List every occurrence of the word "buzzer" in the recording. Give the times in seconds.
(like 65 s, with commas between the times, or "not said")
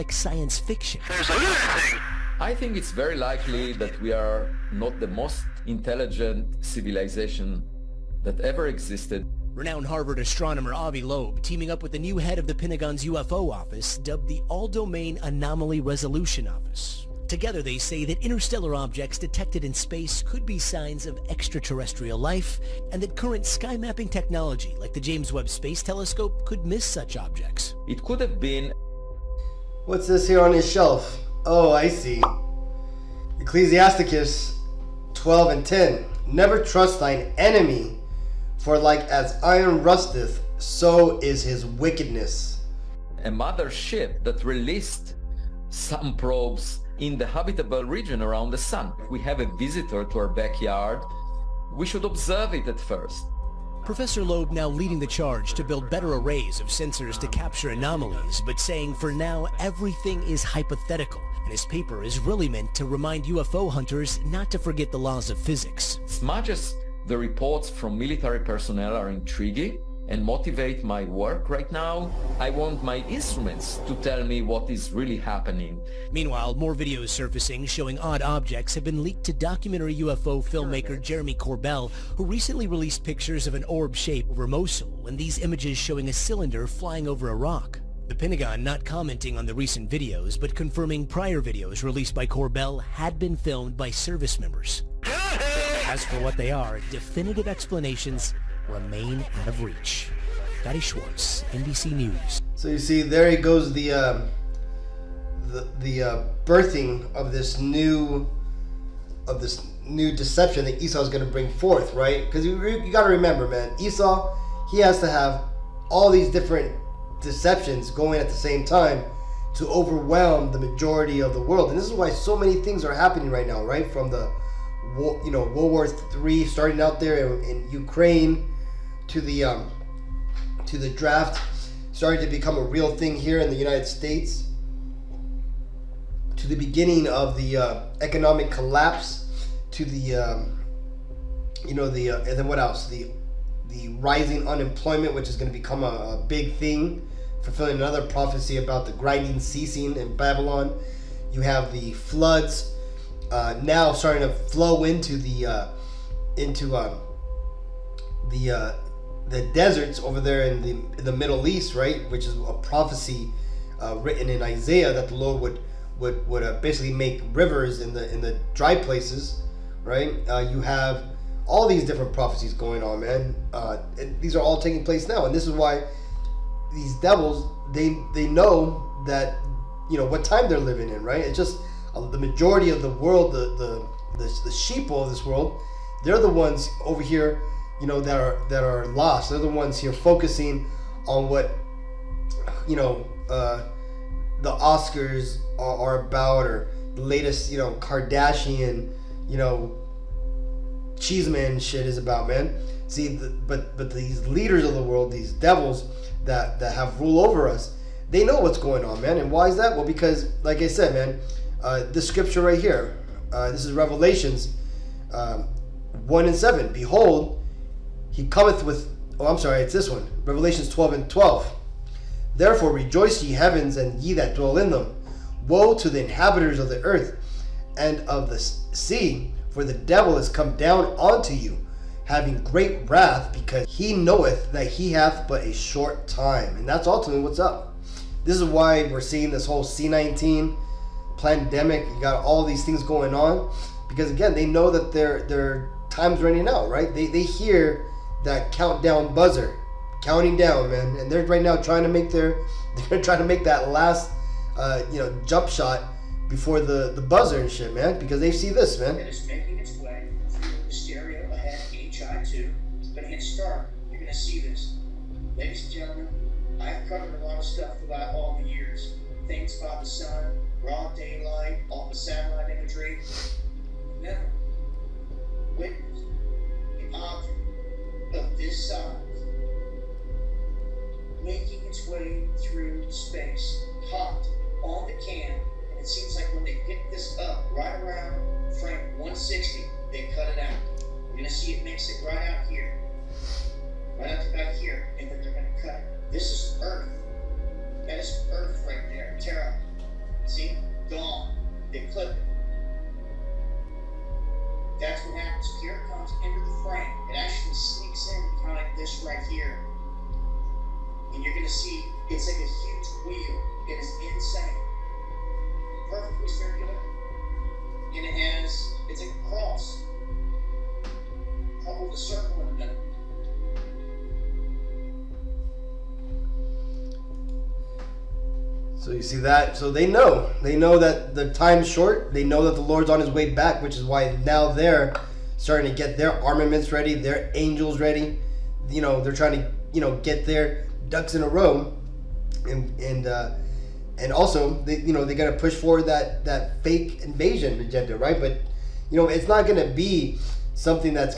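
249 s, 257 s.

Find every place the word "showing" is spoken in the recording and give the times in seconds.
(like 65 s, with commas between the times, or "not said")
77 s, 85 s.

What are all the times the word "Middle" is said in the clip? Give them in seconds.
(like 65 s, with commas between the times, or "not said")
161 s.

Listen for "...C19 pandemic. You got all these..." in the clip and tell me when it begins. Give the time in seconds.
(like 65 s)
239 s.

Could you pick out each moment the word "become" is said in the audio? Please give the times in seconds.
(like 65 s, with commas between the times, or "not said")
132 s, 145 s.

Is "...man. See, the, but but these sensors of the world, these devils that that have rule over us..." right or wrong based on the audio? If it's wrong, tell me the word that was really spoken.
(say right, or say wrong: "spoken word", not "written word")
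wrong: "leaders", not "sensors".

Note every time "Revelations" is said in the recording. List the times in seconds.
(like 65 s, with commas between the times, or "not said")
213 s, 220 s.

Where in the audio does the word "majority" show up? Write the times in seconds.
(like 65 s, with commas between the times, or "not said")
120 s, 182 s.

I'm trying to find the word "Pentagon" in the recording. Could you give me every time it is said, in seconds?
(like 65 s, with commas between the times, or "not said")
12 s, 88 s.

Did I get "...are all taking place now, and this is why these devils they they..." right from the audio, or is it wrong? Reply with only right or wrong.
right.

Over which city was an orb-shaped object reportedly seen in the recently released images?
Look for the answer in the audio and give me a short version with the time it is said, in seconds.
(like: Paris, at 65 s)
Mosul, at 84 s.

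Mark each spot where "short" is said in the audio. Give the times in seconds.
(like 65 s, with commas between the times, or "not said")
235 s, 331 s.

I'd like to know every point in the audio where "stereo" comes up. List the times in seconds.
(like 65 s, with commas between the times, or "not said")
260 s.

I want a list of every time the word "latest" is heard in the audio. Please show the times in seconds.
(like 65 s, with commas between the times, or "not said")
197 s.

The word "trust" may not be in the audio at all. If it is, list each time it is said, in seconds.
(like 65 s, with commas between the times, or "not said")
36 s.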